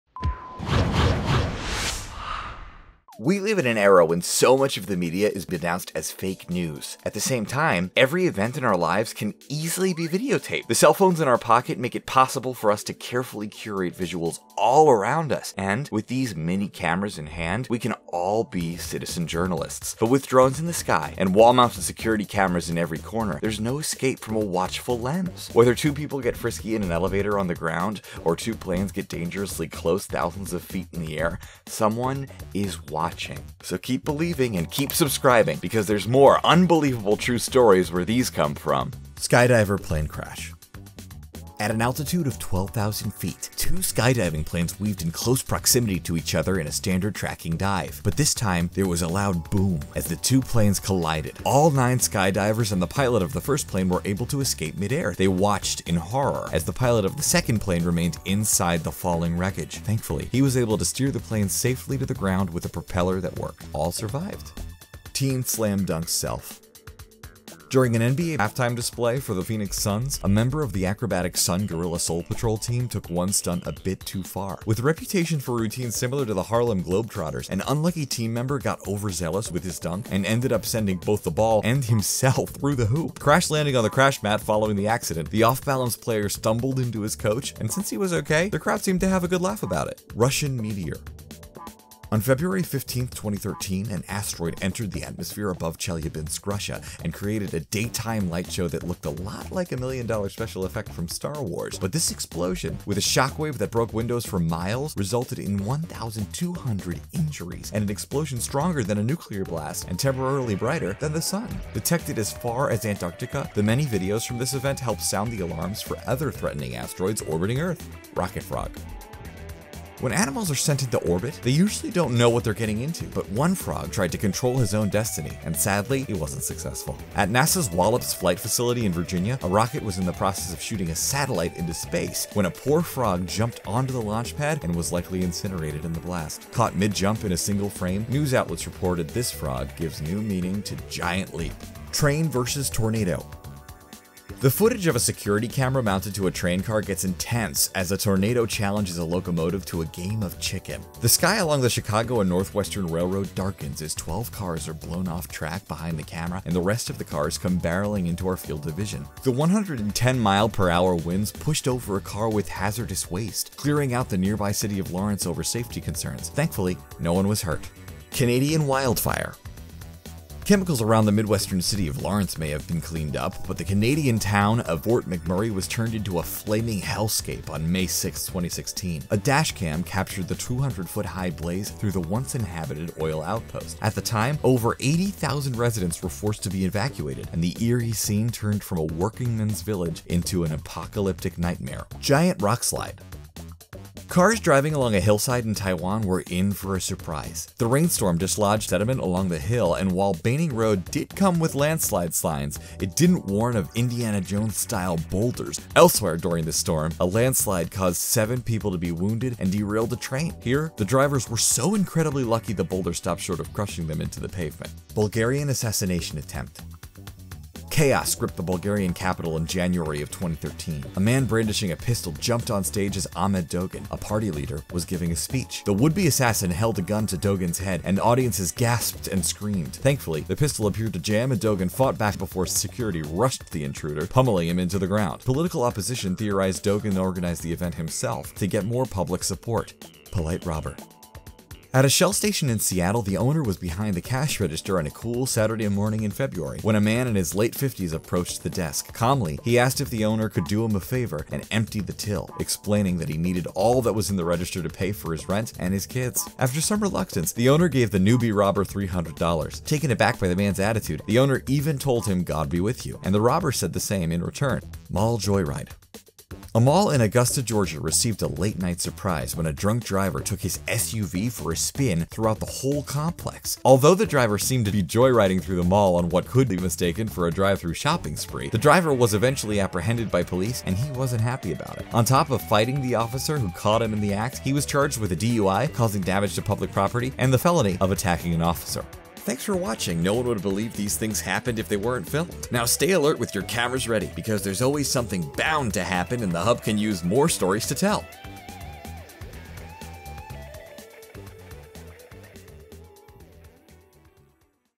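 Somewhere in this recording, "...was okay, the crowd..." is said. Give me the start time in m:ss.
1:27.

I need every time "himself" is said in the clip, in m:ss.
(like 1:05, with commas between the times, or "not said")
1:21, 3:57.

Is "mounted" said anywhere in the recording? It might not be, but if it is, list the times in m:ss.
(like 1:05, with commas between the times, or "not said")
0:21, 2:25.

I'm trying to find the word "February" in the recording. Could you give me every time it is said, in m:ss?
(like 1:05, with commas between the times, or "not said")
1:32, 4:06.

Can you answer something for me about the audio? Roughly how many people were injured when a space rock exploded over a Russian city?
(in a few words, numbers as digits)
1,200.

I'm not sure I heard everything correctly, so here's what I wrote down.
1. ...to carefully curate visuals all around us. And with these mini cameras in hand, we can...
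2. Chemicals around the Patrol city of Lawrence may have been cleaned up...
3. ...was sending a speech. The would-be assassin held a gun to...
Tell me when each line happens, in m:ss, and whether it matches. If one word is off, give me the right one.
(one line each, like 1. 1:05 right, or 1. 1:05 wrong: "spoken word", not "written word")
1. 0:12 right
2. 2:50 wrong: "Midwestern", not "Patrol"
3. 3:44 wrong: "giving", not "sending".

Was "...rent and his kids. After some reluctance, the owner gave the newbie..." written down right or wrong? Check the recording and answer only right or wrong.
right.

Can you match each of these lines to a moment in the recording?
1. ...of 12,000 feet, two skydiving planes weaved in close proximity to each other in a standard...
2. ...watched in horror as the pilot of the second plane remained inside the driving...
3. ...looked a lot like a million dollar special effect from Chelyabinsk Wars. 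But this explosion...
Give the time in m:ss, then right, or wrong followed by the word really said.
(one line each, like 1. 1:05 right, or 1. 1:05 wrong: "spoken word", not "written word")
1. 0:42 right
2. 0:55 wrong: "falling", not "driving"
3. 1:38 wrong: "Star", not "Chelyabinsk".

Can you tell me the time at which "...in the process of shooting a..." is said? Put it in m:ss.
2:09.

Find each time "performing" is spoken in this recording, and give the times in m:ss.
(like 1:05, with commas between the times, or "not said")
not said.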